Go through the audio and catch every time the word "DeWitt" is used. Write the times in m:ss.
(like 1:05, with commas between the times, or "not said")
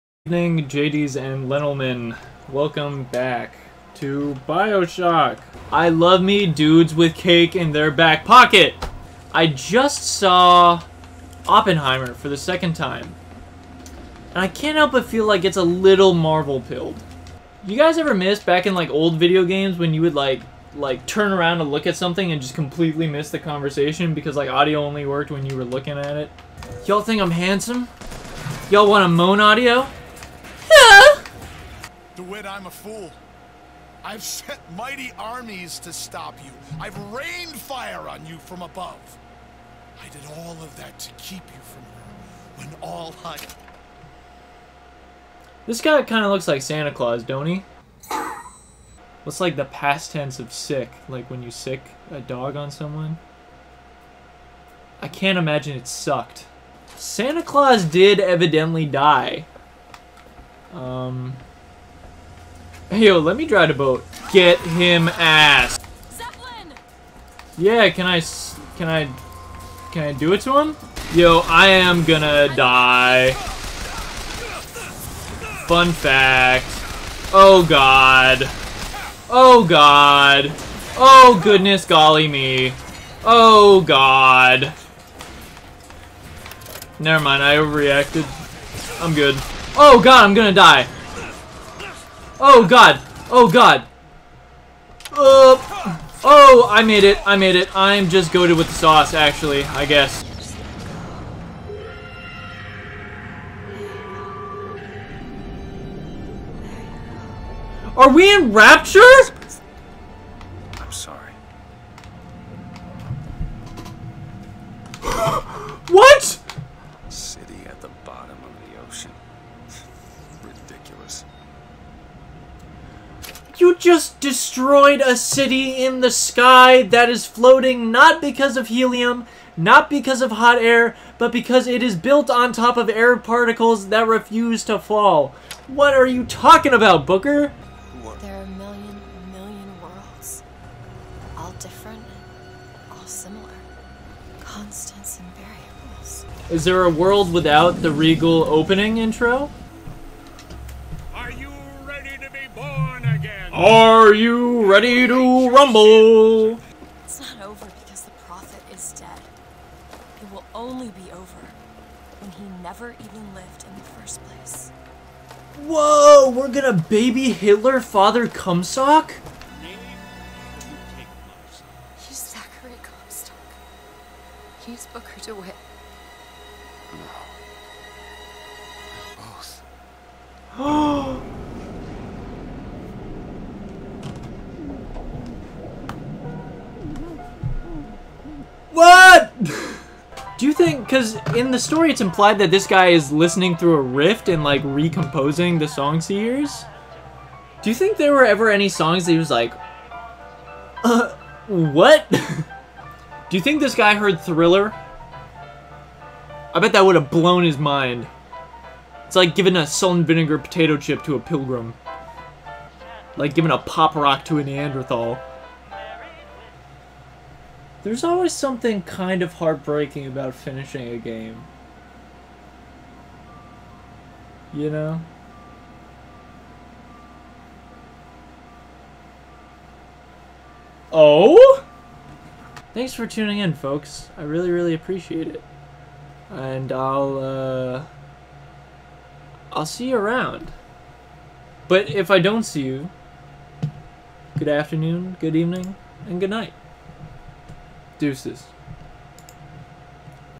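0:32, 2:55.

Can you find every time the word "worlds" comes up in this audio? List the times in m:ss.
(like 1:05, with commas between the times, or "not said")
2:19, 2:26.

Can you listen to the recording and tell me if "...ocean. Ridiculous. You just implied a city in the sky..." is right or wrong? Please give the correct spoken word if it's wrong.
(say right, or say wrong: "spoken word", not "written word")
wrong: "destroyed", not "implied".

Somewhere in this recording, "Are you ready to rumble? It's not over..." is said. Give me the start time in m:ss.
2:33.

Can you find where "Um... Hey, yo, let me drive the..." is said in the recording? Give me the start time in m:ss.
1:00.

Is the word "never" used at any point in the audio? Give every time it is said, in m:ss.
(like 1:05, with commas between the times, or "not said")
1:26, 2:42.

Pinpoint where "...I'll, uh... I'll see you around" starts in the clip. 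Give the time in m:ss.
3:56.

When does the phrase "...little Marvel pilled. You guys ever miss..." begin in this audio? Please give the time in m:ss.
0:15.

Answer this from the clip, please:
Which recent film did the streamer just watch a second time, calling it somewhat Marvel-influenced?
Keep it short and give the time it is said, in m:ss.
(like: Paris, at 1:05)
Oppenheimer, at 0:11.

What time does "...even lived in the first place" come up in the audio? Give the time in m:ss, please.
2:42.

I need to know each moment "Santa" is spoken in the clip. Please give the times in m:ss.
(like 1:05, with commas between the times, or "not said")
0:46, 0:56.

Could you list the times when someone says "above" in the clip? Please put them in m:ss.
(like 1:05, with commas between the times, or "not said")
0:38.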